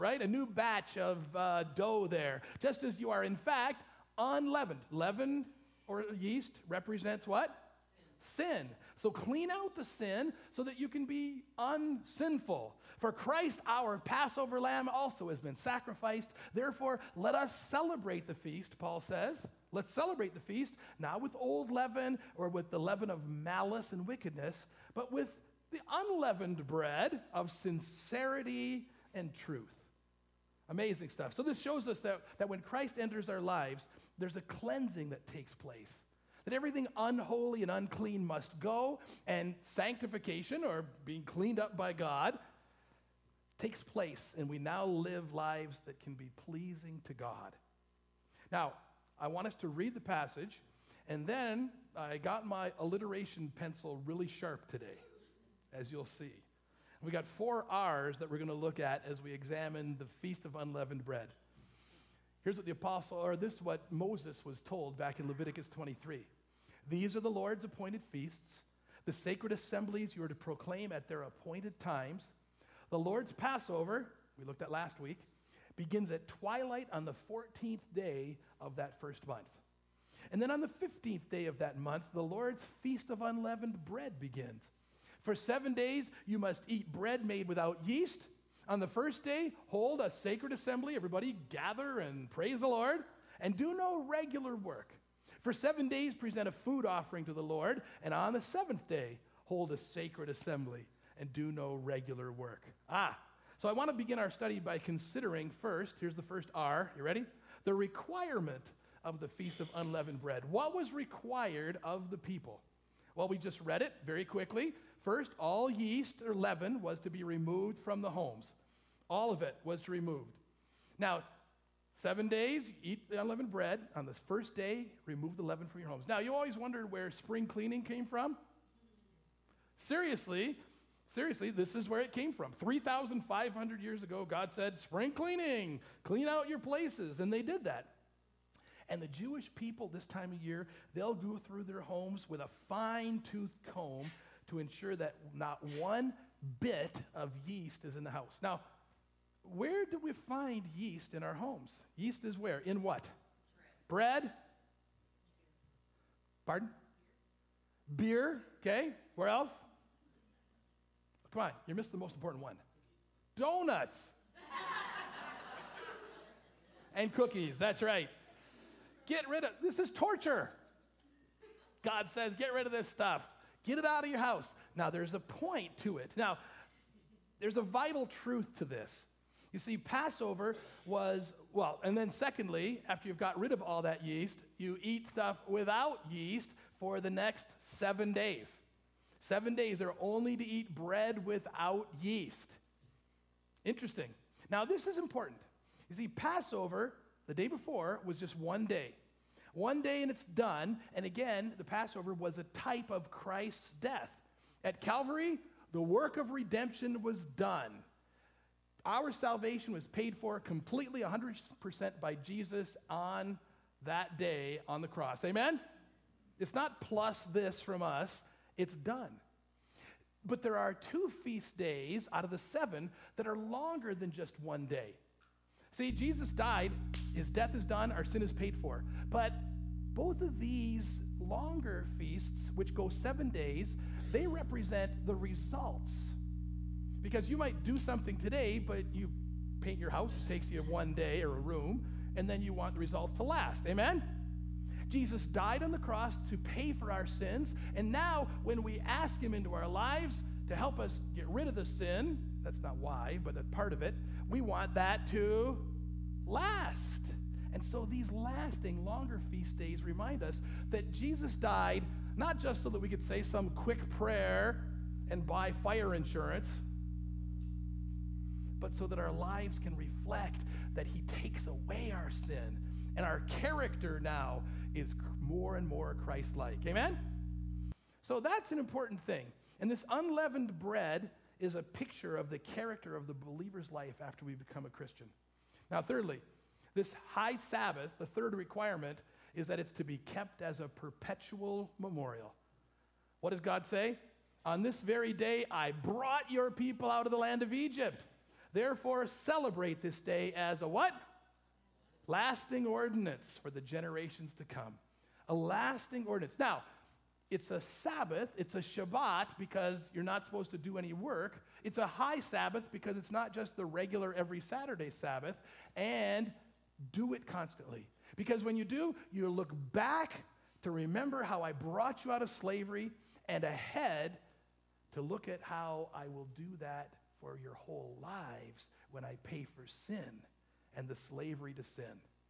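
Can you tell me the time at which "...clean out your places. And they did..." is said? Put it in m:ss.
2:16.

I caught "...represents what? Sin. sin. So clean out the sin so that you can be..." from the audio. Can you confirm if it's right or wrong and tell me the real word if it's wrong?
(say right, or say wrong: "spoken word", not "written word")
right.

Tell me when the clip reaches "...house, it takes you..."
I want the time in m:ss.
3:59.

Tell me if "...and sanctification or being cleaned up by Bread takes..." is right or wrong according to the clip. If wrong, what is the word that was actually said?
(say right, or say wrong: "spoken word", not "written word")
wrong: "God", not "Bread".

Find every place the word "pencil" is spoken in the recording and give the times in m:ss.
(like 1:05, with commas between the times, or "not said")
0:53.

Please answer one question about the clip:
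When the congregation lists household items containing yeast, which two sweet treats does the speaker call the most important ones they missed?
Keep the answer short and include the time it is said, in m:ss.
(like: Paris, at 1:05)
donuts and cookies, at 2:43.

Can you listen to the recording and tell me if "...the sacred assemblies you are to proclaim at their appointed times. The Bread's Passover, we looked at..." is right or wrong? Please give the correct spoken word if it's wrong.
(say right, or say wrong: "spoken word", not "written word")
wrong: "Lord", not "Bread".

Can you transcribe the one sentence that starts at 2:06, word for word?
Now, you always wondered where spring cleaning came from?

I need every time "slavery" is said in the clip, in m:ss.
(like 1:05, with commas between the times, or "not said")
5:22, 5:31.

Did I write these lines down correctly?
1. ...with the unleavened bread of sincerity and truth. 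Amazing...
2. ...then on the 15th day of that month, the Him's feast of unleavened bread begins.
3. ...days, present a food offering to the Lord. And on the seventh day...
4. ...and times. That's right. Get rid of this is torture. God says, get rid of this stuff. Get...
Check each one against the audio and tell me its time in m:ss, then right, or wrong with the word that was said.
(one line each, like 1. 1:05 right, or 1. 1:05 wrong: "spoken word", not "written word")
1. 0:25 right
2. 1:20 wrong: "Lord", not "Him"
3. 1:35 right
4. 2:46 wrong: "cookies", not "times".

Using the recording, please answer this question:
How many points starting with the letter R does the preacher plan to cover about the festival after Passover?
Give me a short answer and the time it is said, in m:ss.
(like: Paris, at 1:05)
4, at 0:57.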